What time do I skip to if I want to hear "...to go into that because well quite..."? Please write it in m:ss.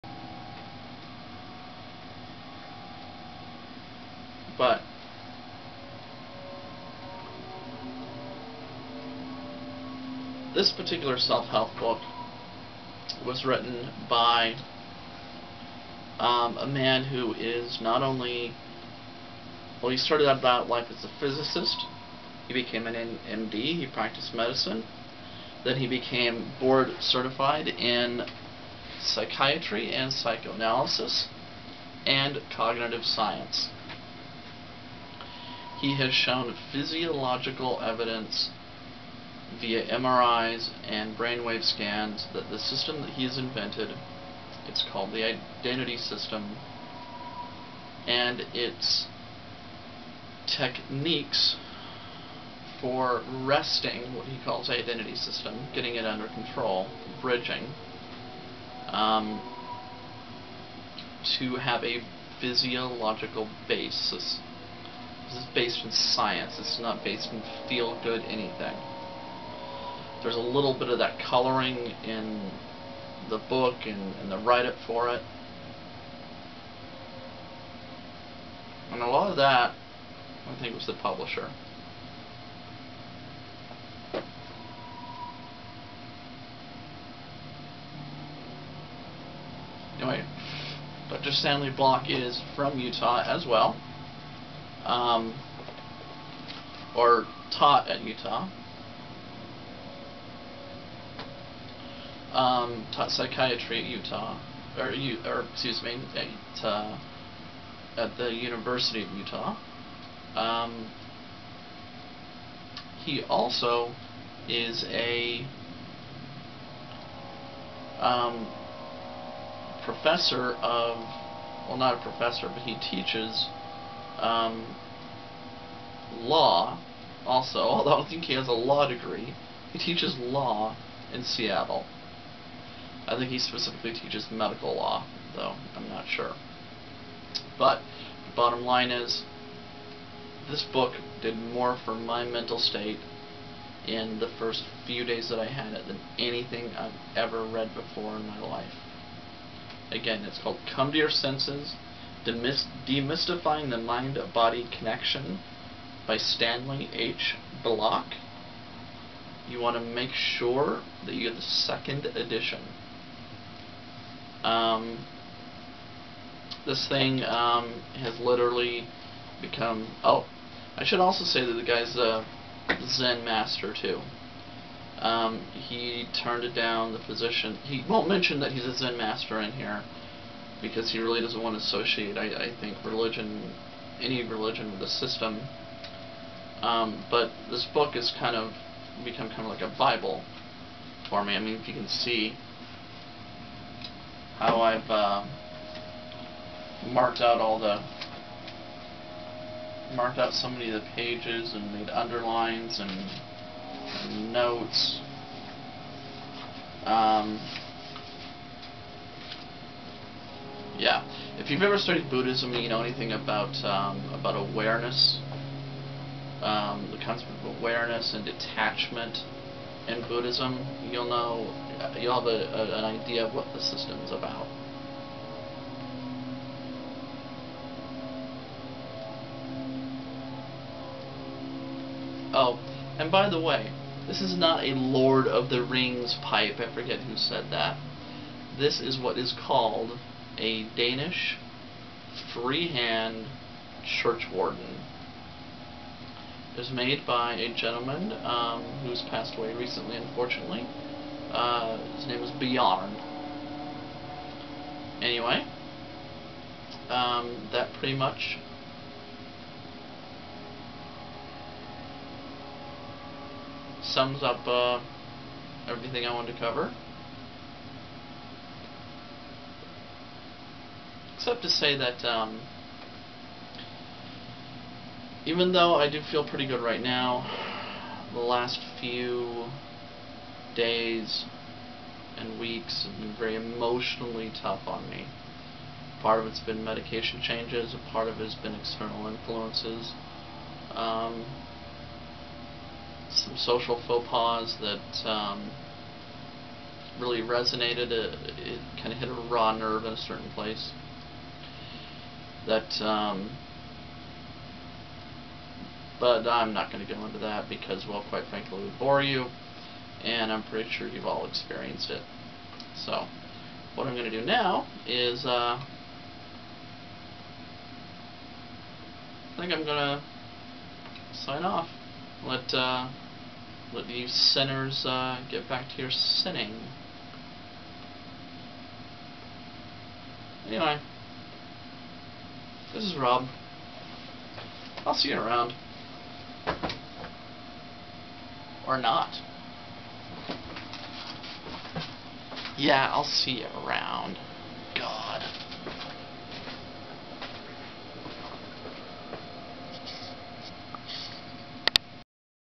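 5:06.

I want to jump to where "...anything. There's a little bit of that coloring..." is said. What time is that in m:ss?
1:08.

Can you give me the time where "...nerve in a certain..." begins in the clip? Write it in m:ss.
4:59.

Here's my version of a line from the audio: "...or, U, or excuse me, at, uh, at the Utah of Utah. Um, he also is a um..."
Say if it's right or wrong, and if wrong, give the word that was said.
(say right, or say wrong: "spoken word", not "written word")
wrong: "University", not "Utah".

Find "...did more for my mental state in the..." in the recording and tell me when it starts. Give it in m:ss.
2:21.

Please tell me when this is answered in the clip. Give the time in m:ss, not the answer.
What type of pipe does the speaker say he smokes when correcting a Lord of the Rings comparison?
4:00.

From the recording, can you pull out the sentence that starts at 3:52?
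Oh, and by the way, this is not a Lord of the Rings pipe.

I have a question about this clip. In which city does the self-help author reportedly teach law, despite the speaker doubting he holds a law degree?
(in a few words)
Seattle.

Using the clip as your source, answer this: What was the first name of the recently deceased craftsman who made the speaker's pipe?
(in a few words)
Bjorn.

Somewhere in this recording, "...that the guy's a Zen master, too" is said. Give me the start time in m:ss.
2:51.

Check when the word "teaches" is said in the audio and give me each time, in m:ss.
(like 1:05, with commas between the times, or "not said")
2:02, 2:09, 2:13.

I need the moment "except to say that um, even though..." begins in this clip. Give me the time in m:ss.
4:31.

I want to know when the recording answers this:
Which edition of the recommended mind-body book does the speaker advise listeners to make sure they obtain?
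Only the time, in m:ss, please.
2:41.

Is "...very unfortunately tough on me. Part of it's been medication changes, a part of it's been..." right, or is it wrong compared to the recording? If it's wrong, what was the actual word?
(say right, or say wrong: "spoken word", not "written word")
wrong: "emotionally", not "unfortunately".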